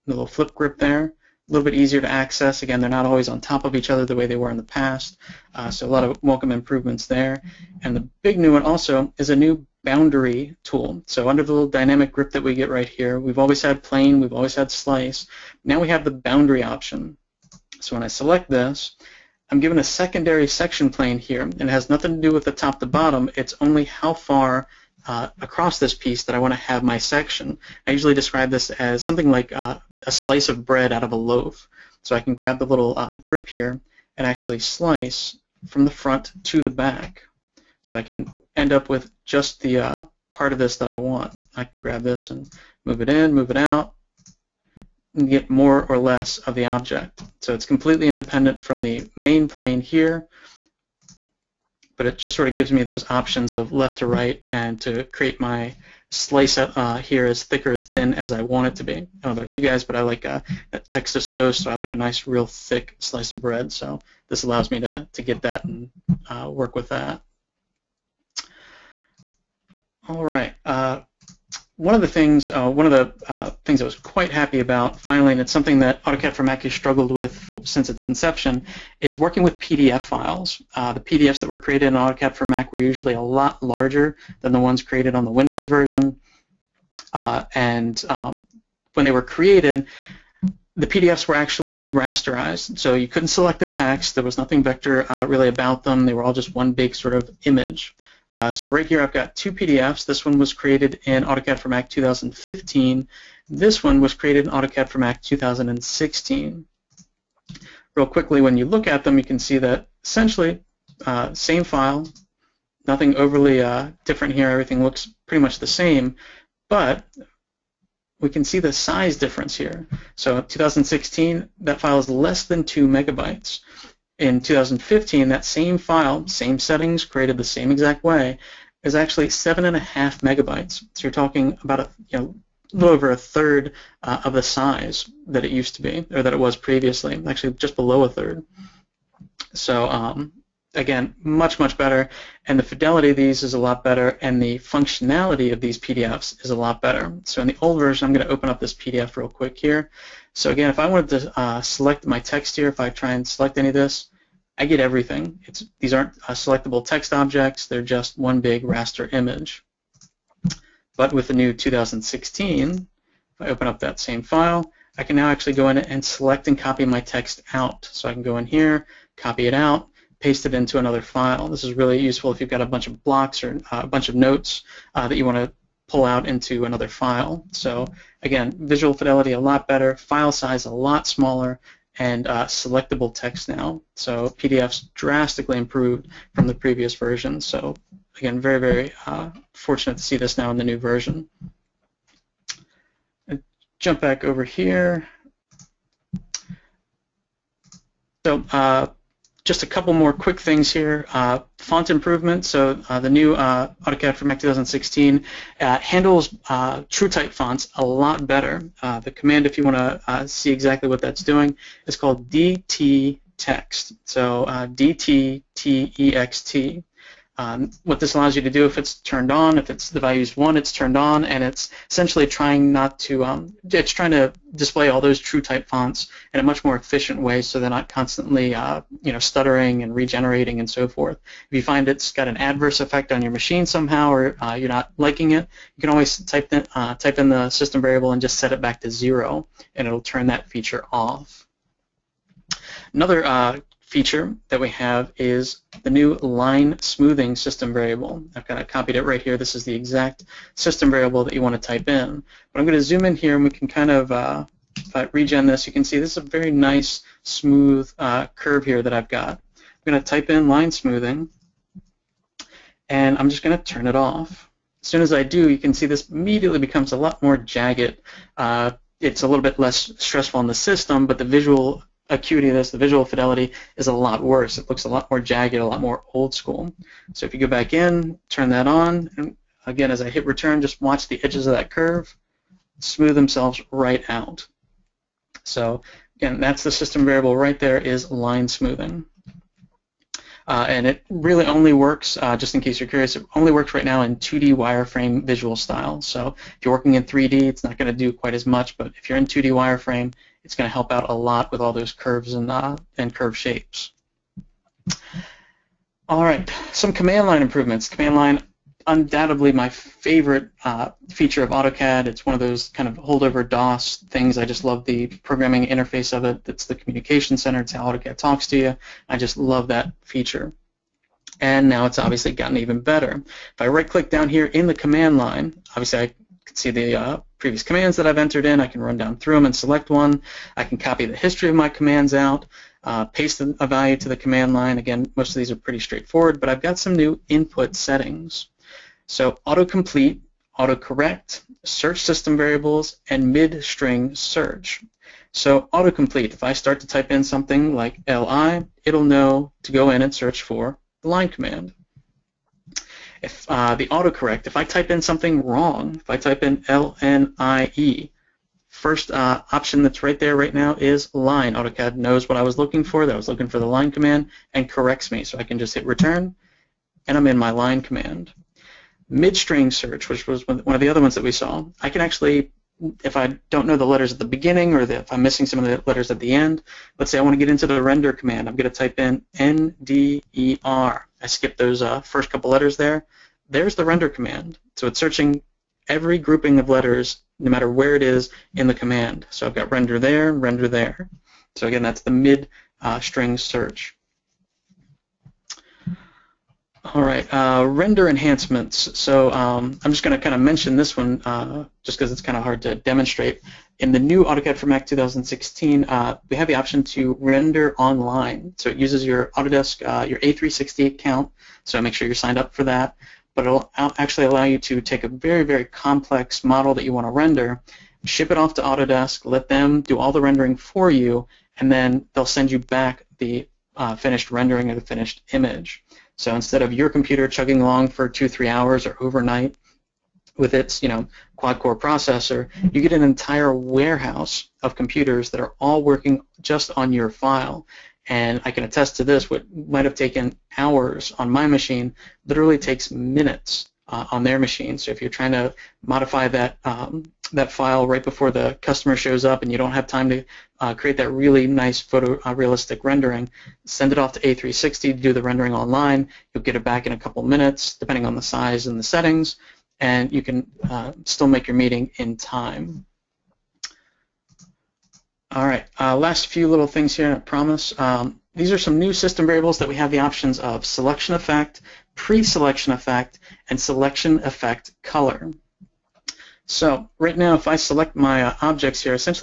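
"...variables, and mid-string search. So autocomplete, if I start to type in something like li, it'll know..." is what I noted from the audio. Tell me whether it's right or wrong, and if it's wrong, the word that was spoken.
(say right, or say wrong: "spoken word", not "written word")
right.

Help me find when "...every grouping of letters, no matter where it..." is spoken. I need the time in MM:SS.
06:25.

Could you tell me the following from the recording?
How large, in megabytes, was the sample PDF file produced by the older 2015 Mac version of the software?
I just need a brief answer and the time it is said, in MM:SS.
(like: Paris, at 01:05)
7.5 megabytes, at 02:09.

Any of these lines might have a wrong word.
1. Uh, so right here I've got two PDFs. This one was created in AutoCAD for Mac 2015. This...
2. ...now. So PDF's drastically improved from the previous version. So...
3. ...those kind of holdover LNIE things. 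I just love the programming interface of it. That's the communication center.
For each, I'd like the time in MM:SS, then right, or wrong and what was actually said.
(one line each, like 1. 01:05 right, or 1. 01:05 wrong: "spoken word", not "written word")
1. 01:38 right
2. 03:03 right
3. 05:12 wrong: "DOS", not "LNIE".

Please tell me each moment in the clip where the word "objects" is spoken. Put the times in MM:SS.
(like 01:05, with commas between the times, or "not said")
00:46, 02:37, 07:58.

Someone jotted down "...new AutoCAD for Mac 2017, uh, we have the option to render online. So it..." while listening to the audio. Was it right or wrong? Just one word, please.
wrong.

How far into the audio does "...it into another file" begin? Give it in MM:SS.
02:50.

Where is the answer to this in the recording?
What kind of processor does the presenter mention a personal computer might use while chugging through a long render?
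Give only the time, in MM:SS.
07:11.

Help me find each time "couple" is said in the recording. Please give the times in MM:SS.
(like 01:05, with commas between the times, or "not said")
03:19, 06:22, 07:36.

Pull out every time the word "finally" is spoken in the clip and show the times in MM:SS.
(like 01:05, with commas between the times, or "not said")
01:14.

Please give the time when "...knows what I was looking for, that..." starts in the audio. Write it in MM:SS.
06:01.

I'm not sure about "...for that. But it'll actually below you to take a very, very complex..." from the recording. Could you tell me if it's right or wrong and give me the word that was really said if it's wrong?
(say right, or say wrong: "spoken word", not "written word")
wrong: "allow", not "below".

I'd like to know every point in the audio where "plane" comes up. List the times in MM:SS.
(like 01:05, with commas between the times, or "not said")
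00:13, 00:20, 00:49.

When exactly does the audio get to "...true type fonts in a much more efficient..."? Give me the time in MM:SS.
03:45.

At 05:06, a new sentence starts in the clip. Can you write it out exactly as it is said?
All right, some command line improvements.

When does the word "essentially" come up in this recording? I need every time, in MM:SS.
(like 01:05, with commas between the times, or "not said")
01:50, 03:41.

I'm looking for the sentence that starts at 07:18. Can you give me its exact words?
And I can attest to this, what might have taken hours on my machine literally takes minutes uh, on their machine.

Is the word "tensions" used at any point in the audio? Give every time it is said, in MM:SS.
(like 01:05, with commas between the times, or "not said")
not said.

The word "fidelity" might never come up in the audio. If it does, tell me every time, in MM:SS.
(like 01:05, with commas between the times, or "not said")
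02:22, 02:58, 04:33.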